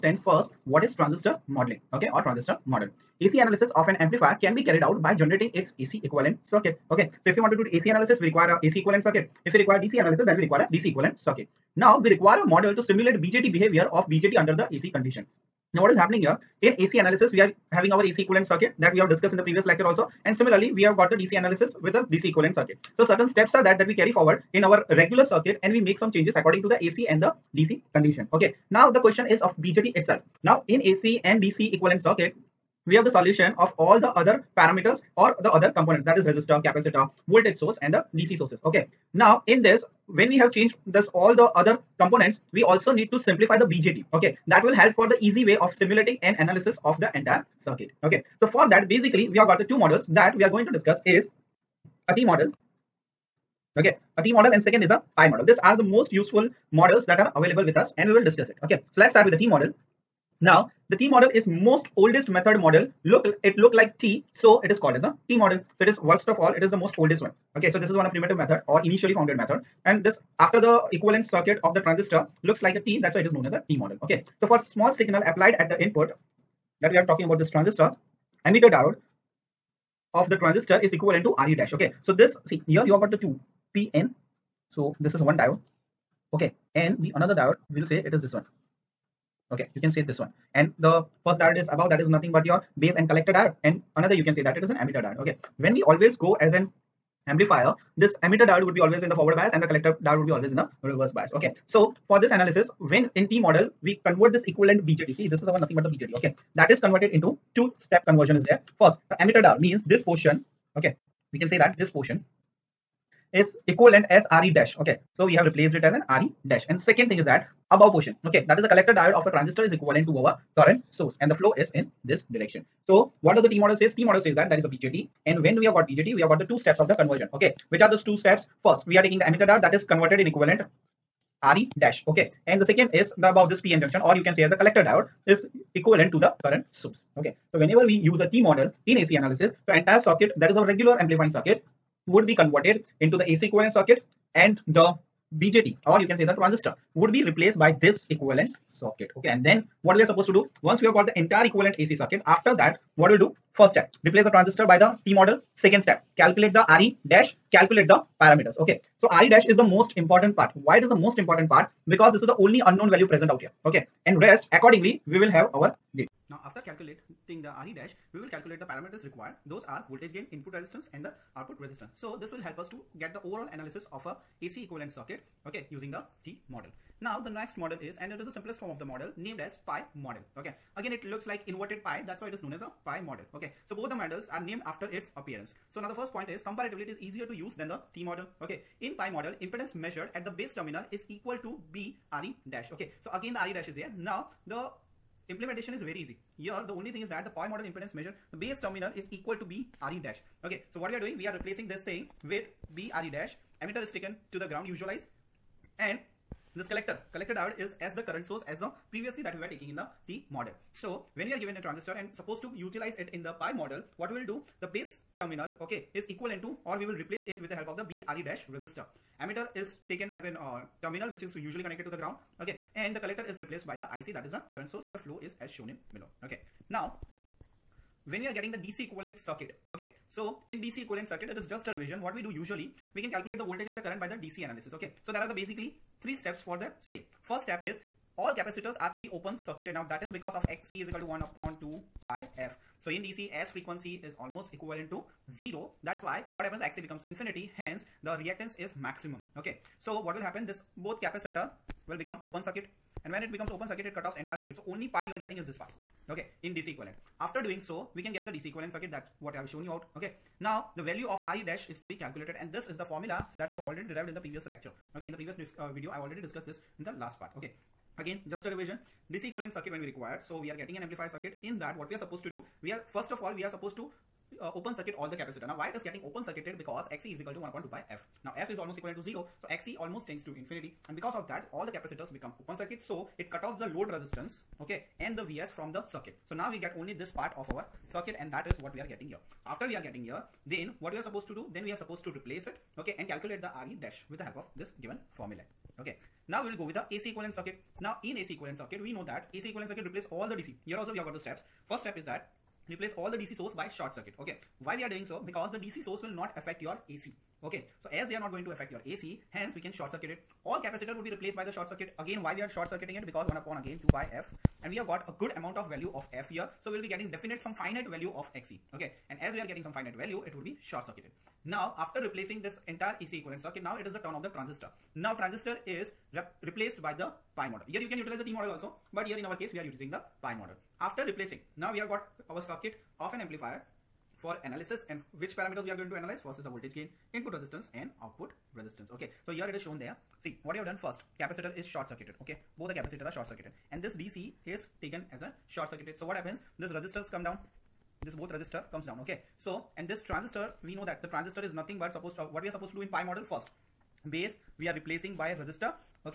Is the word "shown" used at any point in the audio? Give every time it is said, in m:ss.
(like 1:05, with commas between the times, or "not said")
3:45, 4:19, 5:39.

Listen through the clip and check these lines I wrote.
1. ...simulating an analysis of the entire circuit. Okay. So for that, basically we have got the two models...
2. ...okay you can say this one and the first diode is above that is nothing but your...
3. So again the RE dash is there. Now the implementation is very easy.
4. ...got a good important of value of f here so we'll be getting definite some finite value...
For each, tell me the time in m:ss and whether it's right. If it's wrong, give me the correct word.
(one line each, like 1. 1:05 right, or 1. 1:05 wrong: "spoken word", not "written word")
1. 0:45 right
2. 1:29 right
3. 3:13 right
4. 5:14 wrong: "amount", not "important".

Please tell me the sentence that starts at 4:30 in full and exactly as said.
So we are getting an amplifier circuit.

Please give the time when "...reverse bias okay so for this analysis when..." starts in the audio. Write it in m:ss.
1:40.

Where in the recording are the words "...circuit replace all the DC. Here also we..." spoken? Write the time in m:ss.
4:59.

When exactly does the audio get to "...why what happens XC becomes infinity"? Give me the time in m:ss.
4:06.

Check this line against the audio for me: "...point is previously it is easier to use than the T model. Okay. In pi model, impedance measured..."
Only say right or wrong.
wrong.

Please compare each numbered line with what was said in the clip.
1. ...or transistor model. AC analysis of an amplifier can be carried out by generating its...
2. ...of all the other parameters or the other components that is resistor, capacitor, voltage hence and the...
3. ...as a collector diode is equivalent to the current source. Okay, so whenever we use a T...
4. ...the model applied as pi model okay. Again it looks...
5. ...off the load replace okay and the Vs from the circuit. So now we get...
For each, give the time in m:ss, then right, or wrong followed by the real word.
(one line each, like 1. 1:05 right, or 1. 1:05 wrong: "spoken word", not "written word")
1. 0:02 right
2. 0:33 wrong: "source", not "hence"
3. 2:14 right
4. 2:58 wrong: "named", not "applied"
5. 4:43 wrong: "resistance", not "replace".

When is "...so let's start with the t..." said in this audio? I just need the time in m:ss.
0:58.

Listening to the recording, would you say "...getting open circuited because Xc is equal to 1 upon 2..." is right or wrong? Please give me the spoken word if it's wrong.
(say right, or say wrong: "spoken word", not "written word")
right.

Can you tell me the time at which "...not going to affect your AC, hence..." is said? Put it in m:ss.
5:08.